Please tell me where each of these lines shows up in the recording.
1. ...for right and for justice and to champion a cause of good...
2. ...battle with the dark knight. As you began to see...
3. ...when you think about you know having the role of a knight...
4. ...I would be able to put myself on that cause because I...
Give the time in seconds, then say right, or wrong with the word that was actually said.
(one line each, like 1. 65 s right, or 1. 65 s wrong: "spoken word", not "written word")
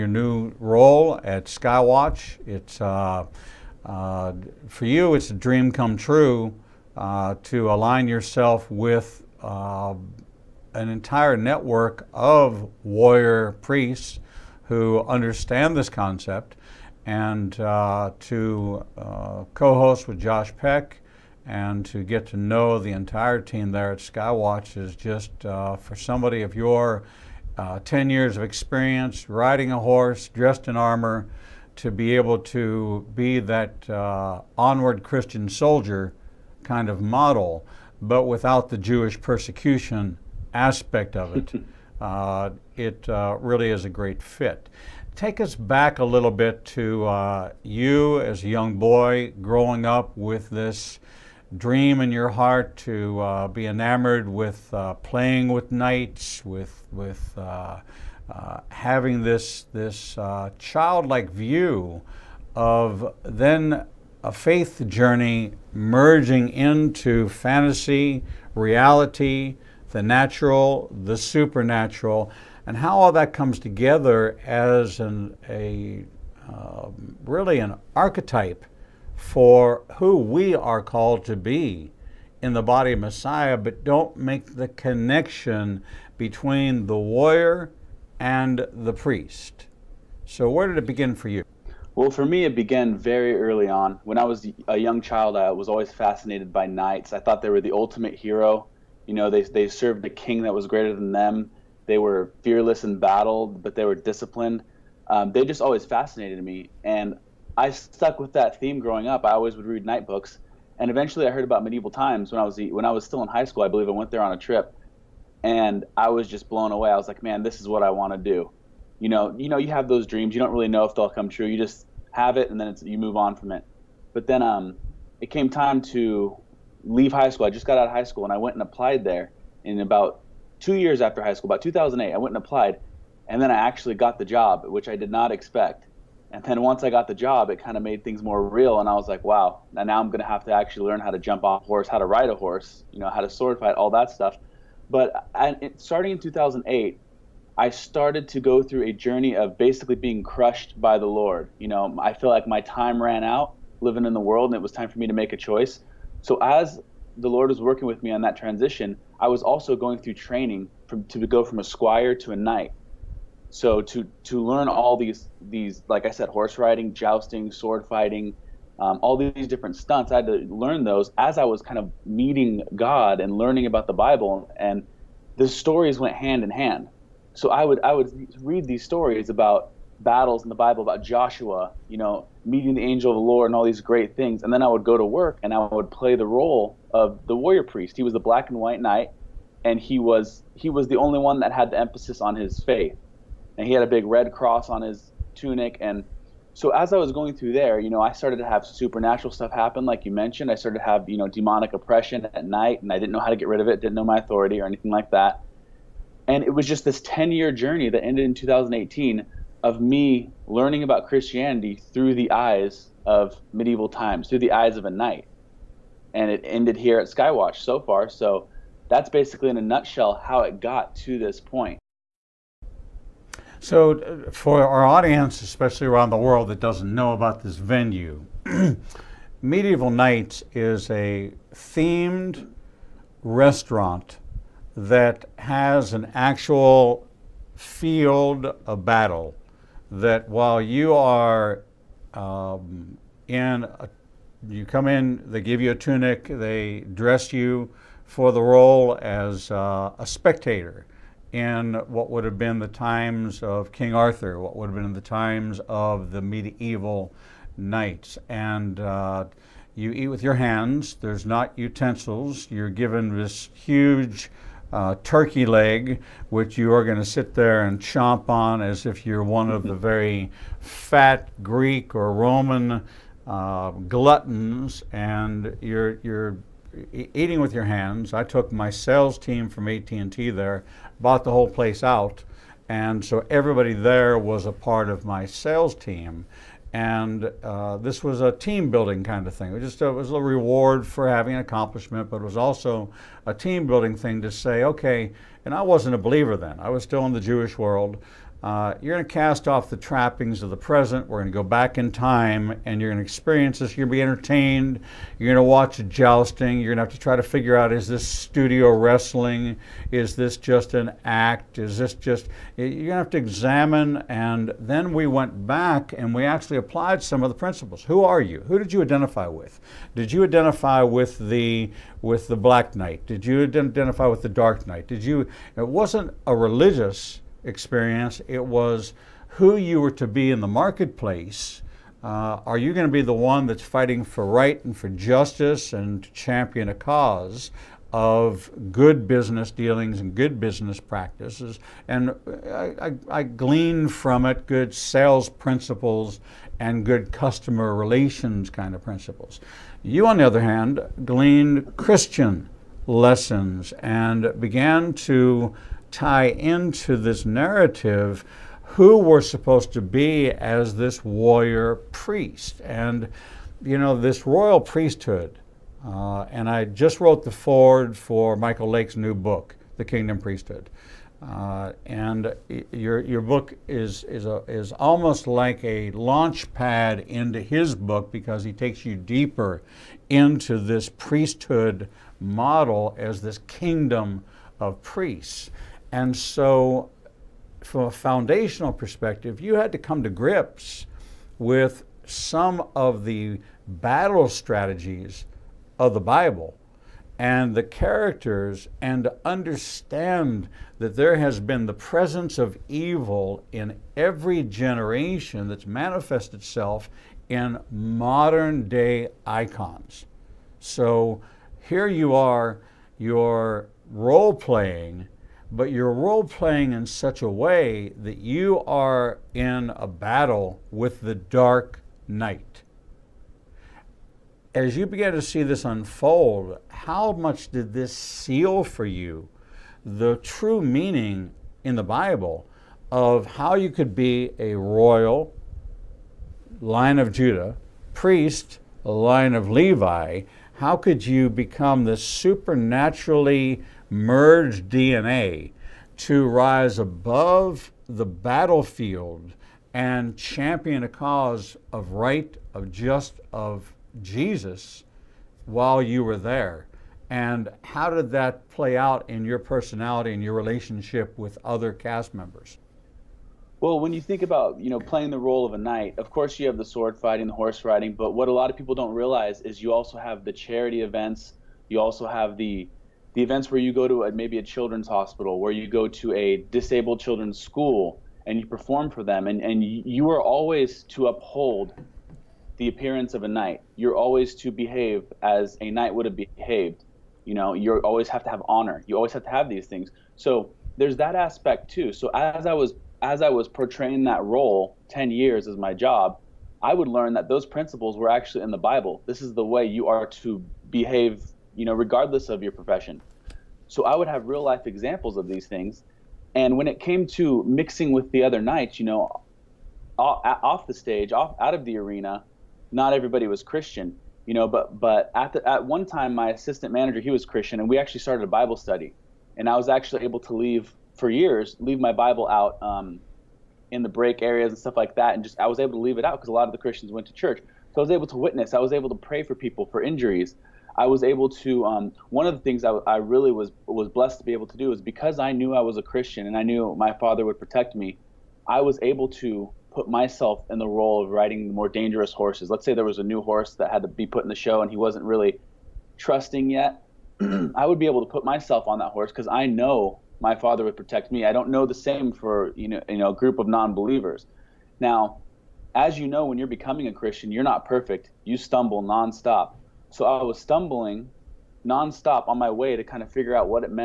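1. 334 s right
2. 419 s right
3. 463 s wrong: "playing", not "having"
4. 547 s wrong: "horse", not "cause".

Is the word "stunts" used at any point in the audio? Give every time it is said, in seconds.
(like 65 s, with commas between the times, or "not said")
169 s.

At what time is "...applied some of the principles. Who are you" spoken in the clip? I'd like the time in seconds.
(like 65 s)
316 s.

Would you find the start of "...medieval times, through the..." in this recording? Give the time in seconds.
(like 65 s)
213 s.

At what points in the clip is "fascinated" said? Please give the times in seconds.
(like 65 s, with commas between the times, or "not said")
95 s, 105 s.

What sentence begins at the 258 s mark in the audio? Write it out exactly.
And uh, you eat with your hands, there's not utensils.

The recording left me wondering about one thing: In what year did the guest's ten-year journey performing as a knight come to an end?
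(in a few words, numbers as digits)
2018.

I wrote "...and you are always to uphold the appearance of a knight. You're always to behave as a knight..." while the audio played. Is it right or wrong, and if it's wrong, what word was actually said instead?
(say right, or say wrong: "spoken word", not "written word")
right.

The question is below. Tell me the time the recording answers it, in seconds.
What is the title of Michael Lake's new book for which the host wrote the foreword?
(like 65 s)
369 s.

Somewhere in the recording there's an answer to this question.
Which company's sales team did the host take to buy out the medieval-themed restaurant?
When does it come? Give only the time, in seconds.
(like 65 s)
279 s.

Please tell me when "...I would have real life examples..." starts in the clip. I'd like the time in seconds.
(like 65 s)
503 s.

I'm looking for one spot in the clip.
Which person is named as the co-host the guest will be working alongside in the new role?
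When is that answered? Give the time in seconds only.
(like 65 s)
20 s.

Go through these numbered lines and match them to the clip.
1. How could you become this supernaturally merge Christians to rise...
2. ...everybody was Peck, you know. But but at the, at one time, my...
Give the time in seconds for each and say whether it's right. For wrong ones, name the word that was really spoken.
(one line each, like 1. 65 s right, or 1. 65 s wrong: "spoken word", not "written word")
1. 440 s wrong: "DNA", not "Christians"
2. 512 s wrong: "Christian", not "Peck".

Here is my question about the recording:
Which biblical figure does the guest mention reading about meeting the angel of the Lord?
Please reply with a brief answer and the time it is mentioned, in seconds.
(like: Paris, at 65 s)
Joshua, at 181 s.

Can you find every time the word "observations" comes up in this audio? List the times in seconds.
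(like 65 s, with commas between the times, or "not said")
not said.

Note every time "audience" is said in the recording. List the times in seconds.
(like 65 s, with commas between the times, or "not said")
224 s.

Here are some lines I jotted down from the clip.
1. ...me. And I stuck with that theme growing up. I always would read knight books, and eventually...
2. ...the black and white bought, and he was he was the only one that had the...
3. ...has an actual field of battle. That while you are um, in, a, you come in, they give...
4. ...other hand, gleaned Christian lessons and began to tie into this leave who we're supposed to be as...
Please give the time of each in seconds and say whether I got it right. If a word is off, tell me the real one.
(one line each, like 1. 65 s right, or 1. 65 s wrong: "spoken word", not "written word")
1. 106 s right
2. 188 s wrong: "knight", not "bought"
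3. 235 s right
4. 350 s wrong: "narrative", not "leave".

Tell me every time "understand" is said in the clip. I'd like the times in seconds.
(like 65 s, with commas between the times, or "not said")
15 s, 399 s.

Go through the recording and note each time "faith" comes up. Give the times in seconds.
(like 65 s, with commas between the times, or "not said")
64 s, 192 s.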